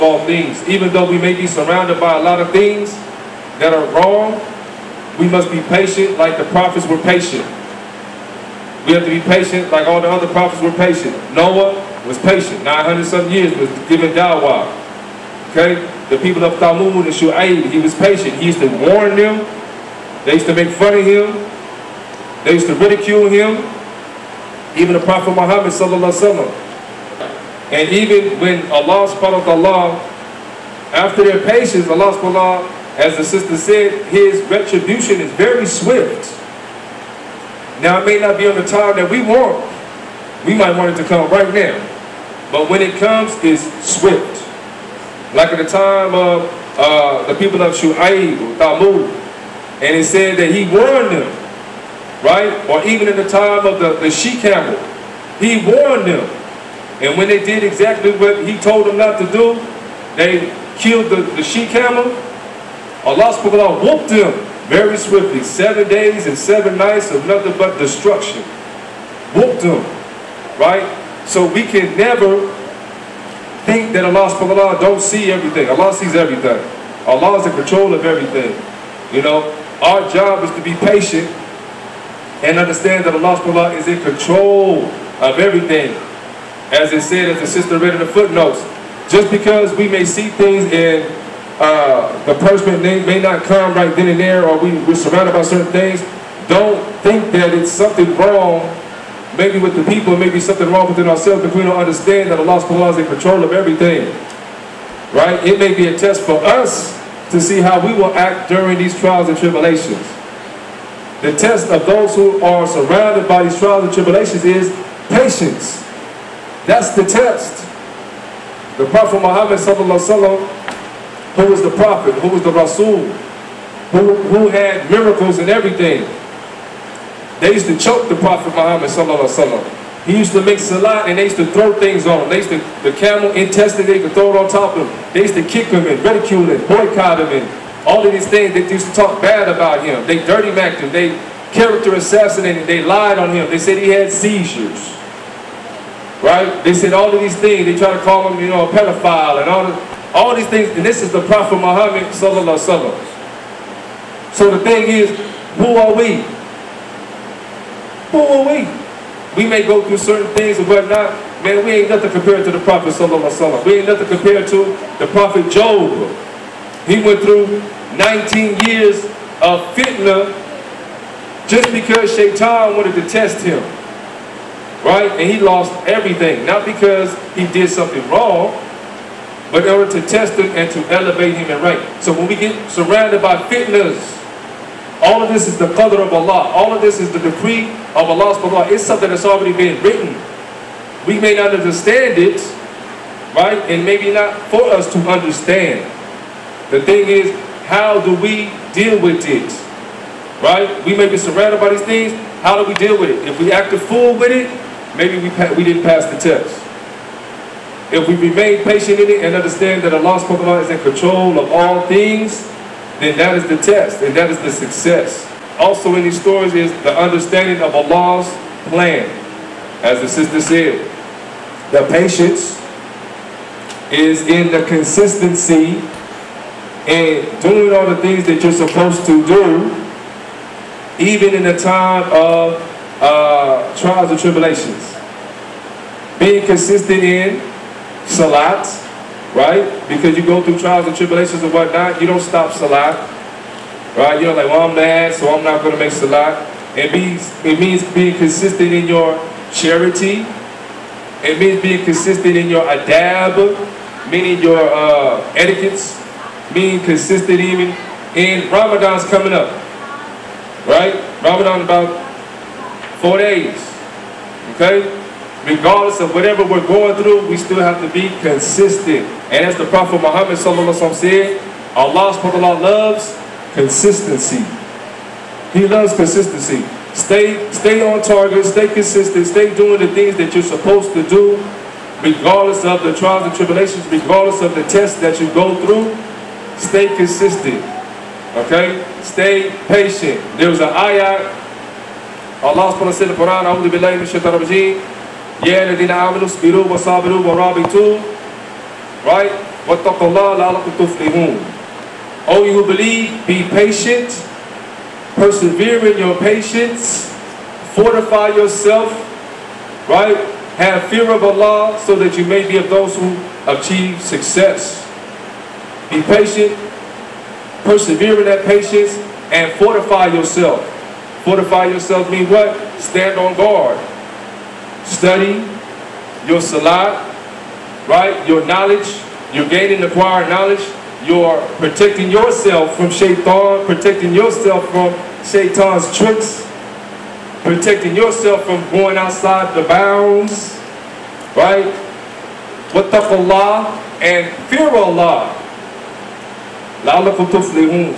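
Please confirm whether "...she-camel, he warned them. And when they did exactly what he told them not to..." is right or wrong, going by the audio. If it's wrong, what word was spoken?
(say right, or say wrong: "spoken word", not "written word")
right.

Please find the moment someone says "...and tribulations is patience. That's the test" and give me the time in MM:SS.
01:53.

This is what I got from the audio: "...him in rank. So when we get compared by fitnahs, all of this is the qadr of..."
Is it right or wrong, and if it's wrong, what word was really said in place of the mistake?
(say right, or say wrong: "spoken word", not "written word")
wrong: "surrounded", not "compared".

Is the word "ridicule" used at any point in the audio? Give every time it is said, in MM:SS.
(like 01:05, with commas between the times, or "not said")
00:22, 02:16.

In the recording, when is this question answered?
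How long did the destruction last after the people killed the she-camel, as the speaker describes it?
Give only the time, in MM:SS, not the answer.
01:05.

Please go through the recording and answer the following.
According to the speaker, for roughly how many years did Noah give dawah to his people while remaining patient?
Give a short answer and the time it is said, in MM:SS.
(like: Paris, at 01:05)
900 some years, at 00:12.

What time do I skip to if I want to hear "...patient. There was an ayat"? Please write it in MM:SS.
04:49.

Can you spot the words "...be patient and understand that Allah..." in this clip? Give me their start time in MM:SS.
01:20.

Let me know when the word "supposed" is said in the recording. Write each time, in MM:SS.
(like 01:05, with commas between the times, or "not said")
03:48, 04:40.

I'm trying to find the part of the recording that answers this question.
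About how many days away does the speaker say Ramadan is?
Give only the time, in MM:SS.
04:21.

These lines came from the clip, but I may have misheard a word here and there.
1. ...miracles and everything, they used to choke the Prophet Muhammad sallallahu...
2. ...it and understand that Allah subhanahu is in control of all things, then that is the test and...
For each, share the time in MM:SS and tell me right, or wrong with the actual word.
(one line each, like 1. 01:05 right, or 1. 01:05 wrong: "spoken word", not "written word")
1. 02:04 right
2. 03:29 right.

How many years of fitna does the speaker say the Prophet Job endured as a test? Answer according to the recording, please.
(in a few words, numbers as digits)
19.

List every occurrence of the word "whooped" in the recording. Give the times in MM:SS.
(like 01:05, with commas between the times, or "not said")
01:03, 01:09.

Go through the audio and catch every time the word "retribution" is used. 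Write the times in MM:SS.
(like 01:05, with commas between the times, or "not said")
00:34.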